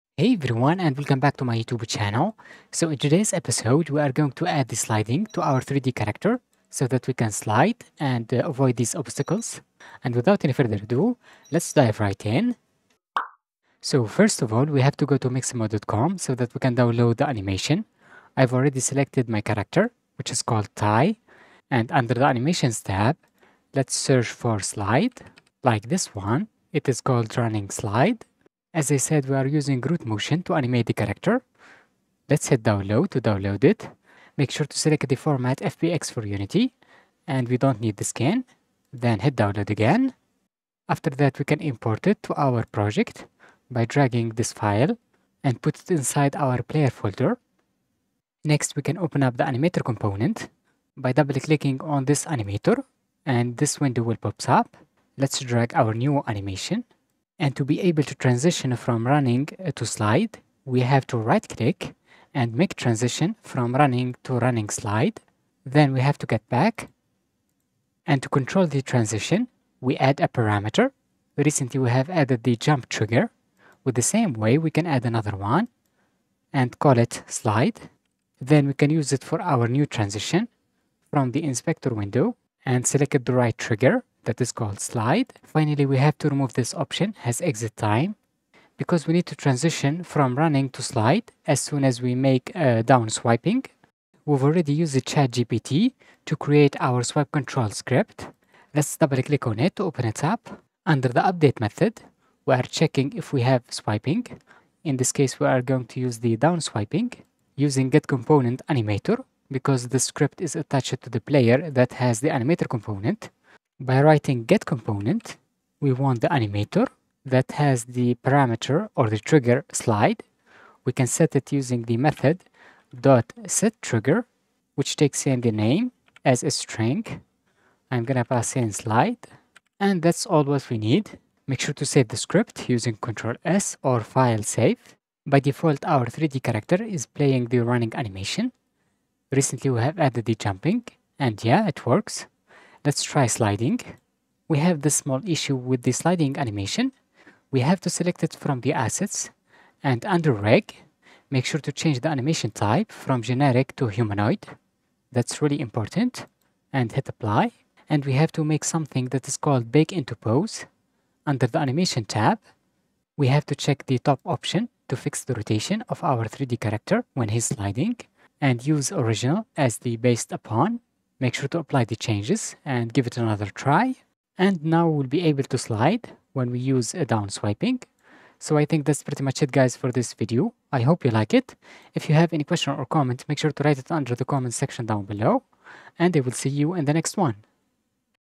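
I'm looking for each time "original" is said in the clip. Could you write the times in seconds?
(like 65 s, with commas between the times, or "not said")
168 s.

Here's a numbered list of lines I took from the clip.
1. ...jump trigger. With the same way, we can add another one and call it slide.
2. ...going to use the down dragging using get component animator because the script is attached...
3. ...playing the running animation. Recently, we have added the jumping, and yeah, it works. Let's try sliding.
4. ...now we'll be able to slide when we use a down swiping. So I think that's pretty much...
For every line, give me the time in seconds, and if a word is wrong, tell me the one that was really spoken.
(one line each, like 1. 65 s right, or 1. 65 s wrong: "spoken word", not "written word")
1. 72 s right
2. 105 s wrong: "swiping", not "dragging"
3. 137 s right
4. 174 s right.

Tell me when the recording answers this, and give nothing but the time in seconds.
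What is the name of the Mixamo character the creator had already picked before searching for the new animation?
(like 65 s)
20 s.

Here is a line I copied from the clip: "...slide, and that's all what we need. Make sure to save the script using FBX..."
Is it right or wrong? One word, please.
wrong.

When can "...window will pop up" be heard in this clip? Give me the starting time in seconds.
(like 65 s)
53 s.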